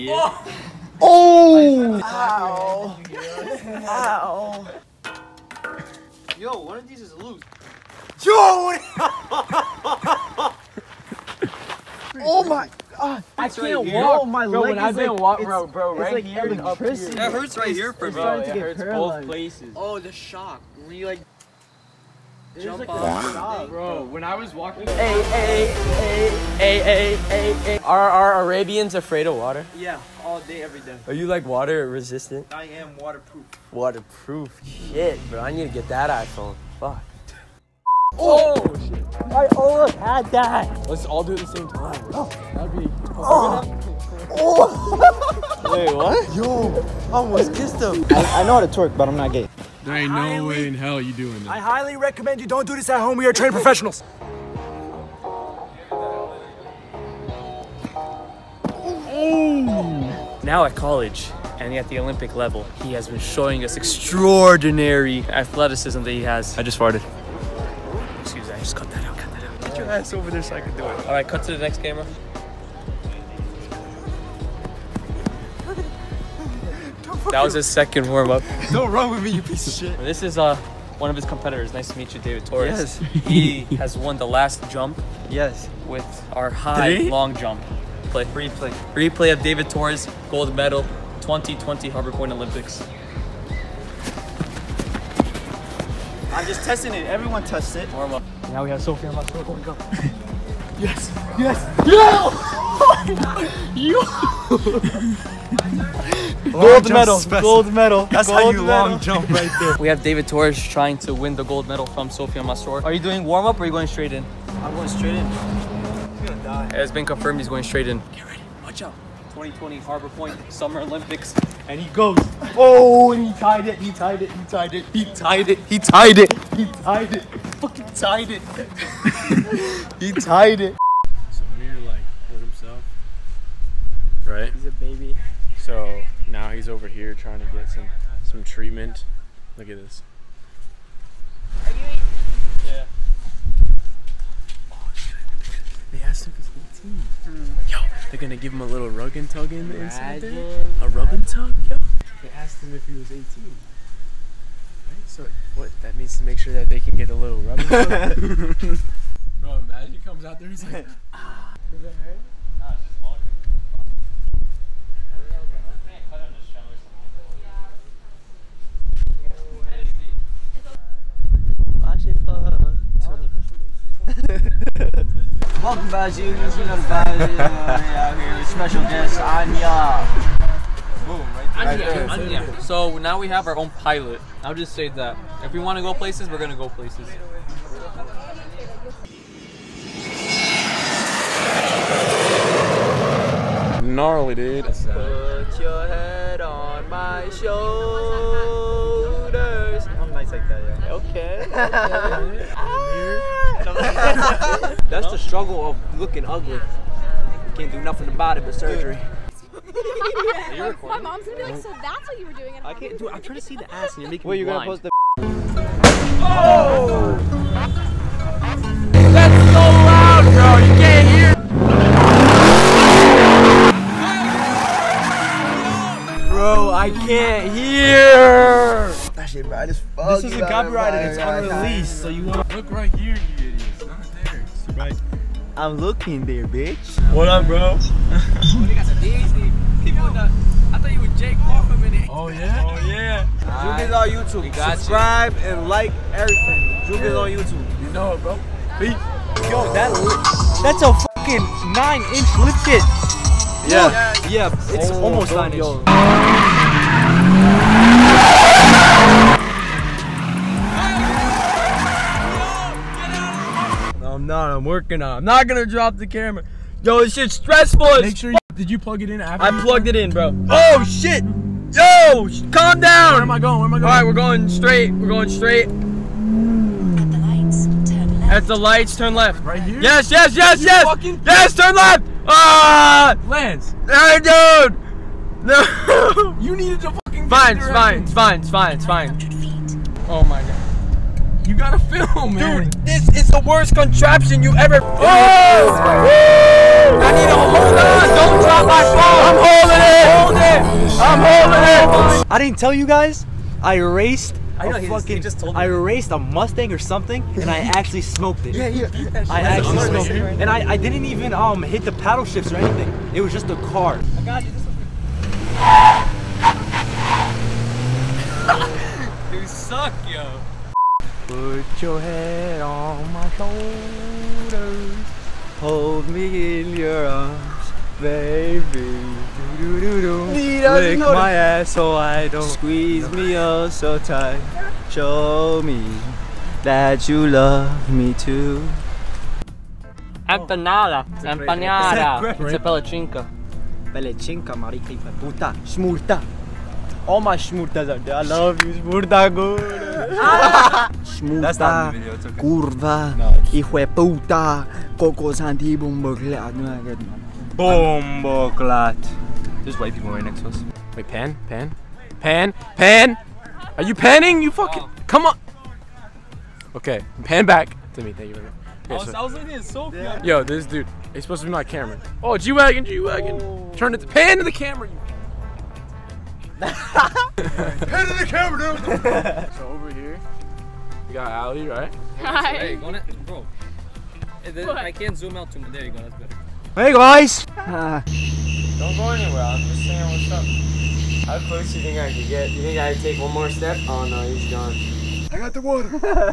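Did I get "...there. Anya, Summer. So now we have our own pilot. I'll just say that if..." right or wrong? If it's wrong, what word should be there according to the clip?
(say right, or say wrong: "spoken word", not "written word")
wrong: "Anya", not "Summer".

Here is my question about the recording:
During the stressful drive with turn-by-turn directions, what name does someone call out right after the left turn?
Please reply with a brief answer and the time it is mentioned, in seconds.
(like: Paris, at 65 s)
Lance, at 283 s.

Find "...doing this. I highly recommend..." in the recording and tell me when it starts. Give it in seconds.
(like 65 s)
51 s.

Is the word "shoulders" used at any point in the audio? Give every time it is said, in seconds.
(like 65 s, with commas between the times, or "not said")
197 s, 323 s.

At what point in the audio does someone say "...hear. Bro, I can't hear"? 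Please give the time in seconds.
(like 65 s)
226 s.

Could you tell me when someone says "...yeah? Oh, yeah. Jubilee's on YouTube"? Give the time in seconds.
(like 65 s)
242 s.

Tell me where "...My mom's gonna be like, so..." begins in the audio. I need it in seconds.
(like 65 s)
210 s.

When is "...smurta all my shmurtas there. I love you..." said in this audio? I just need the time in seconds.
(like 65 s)
345 s.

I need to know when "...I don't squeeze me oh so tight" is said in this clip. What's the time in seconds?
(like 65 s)
331 s.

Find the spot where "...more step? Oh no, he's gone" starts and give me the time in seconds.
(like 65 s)
393 s.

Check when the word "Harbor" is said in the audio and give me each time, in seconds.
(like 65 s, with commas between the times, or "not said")
91 s, 119 s.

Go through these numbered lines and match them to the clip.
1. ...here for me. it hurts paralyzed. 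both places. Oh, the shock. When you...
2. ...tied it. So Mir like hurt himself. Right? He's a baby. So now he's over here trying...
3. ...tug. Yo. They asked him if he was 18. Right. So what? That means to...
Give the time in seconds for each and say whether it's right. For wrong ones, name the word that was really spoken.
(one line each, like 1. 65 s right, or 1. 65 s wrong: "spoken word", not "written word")
1. 17 s right
2. 130 s right
3. 151 s right.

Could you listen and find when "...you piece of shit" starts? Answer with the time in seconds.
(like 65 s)
79 s.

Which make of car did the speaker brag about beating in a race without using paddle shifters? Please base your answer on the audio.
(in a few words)
Mustang.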